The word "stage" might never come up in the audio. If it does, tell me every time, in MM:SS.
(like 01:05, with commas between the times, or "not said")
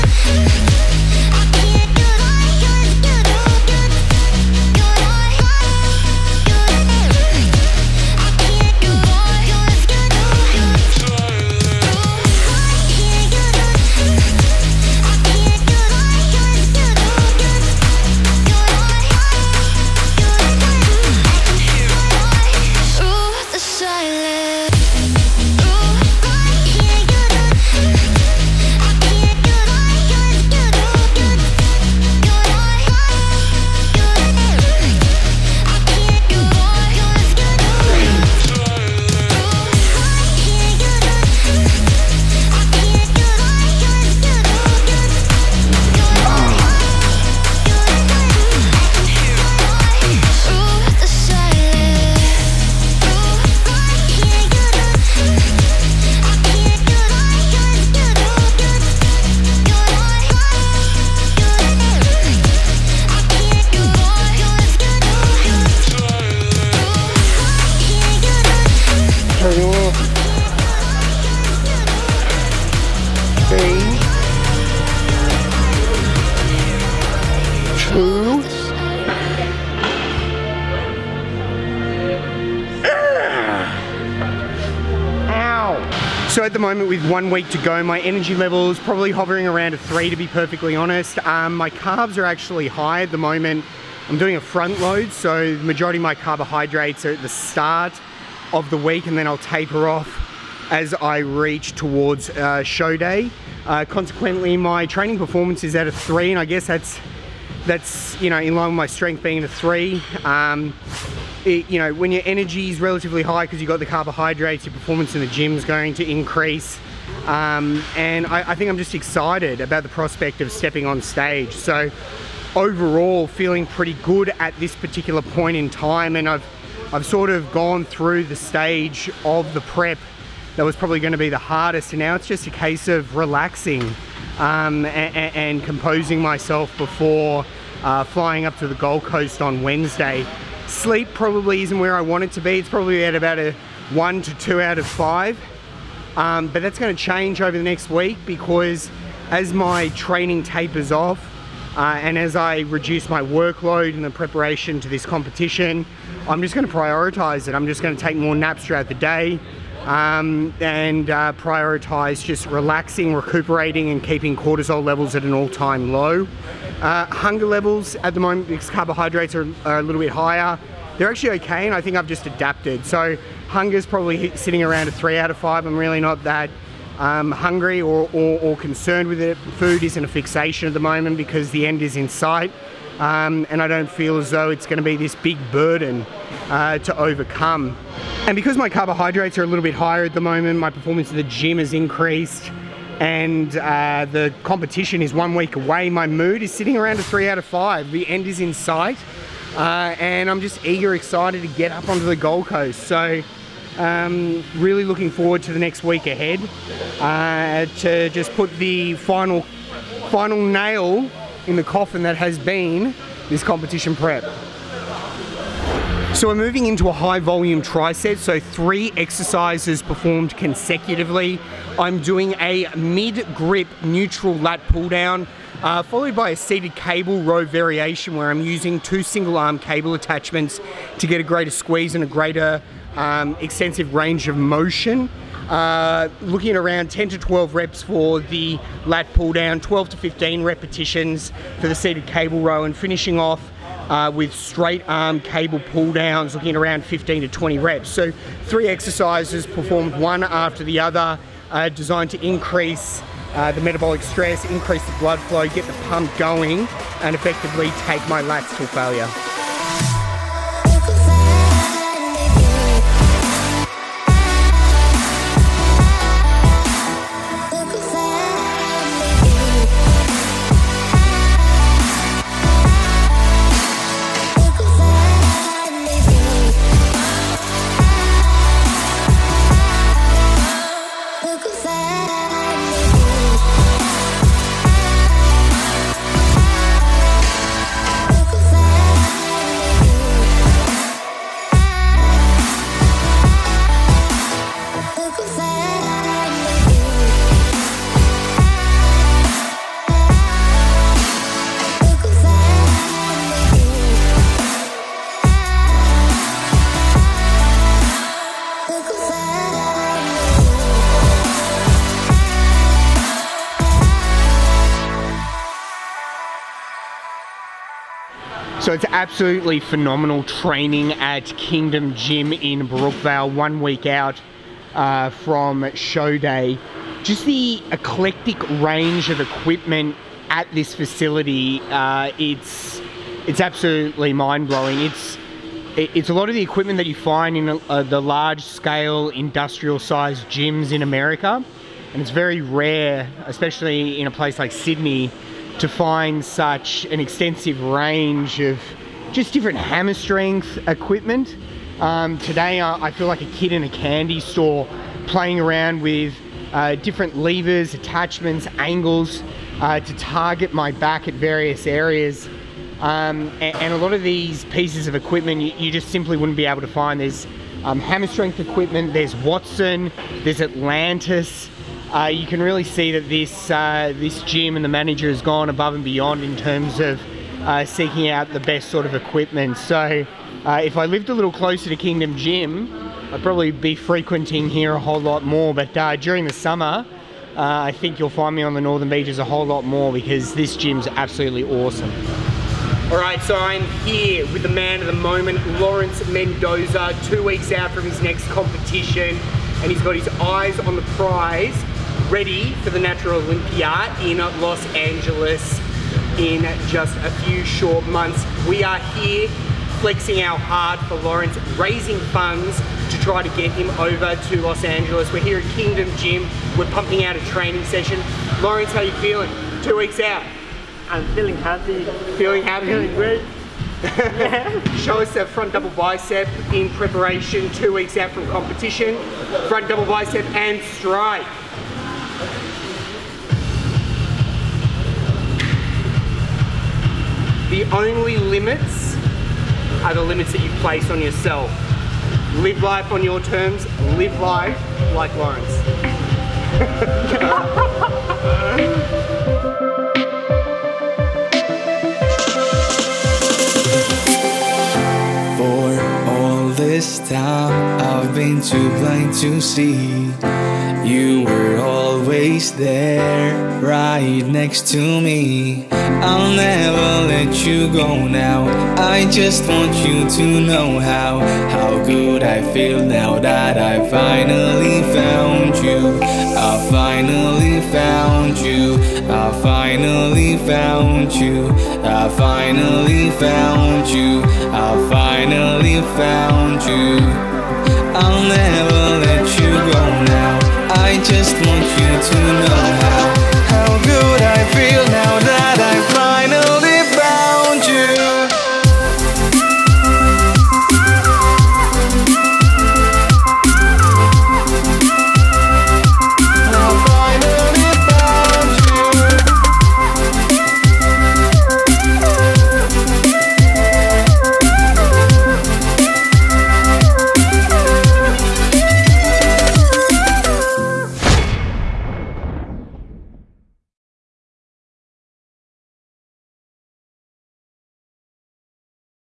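02:01, 02:08.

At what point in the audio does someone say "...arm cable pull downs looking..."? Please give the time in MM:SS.
04:04.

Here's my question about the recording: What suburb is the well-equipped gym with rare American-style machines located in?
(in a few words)
Brookvale.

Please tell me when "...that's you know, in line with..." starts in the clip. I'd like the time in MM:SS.
01:47.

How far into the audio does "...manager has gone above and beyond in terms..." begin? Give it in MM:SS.
06:14.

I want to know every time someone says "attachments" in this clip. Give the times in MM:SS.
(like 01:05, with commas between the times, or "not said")
03:49, 05:57.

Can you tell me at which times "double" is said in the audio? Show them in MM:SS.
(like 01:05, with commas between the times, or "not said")
07:05, 07:09.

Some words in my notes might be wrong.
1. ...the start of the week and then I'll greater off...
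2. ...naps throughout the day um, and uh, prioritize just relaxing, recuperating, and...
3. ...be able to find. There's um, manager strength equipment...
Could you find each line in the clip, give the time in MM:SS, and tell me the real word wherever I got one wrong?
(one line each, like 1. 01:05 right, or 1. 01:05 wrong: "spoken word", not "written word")
1. 01:37 wrong: "taper", not "greater"
2. 02:38 right
3. 06:06 wrong: "hammer", not "manager".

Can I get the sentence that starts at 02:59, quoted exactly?
Food isn't a fixation at the moment because the end is in sight.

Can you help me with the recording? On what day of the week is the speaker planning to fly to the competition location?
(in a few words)
Wednesday.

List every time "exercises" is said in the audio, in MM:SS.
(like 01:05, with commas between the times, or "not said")
03:38, 04:08.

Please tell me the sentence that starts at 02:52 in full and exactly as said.
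So hunger's probably sitting around a three out of five.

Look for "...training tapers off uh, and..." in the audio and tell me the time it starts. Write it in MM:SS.
02:29.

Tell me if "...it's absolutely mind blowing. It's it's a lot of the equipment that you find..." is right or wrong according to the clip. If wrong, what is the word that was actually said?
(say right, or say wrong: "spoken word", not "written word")
right.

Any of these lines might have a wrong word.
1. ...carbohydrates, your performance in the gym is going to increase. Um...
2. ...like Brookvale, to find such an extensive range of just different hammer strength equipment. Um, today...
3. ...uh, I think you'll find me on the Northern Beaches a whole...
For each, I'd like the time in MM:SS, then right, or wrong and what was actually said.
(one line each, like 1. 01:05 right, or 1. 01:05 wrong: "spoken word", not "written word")
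1. 01:53 right
2. 05:44 wrong: "Sydney", not "Brookvale"
3. 06:27 right.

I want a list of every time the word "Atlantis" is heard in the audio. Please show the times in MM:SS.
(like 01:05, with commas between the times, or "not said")
06:10.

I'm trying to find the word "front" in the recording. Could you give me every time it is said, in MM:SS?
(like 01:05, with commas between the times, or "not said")
01:34, 07:05, 07:09.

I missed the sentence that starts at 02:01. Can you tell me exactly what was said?
So overall feeling pretty good at this particular point in time.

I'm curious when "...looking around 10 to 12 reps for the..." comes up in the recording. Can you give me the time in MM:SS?
03:56.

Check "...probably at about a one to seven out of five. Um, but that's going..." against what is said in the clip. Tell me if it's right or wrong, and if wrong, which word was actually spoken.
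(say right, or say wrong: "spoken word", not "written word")
wrong: "two", not "seven".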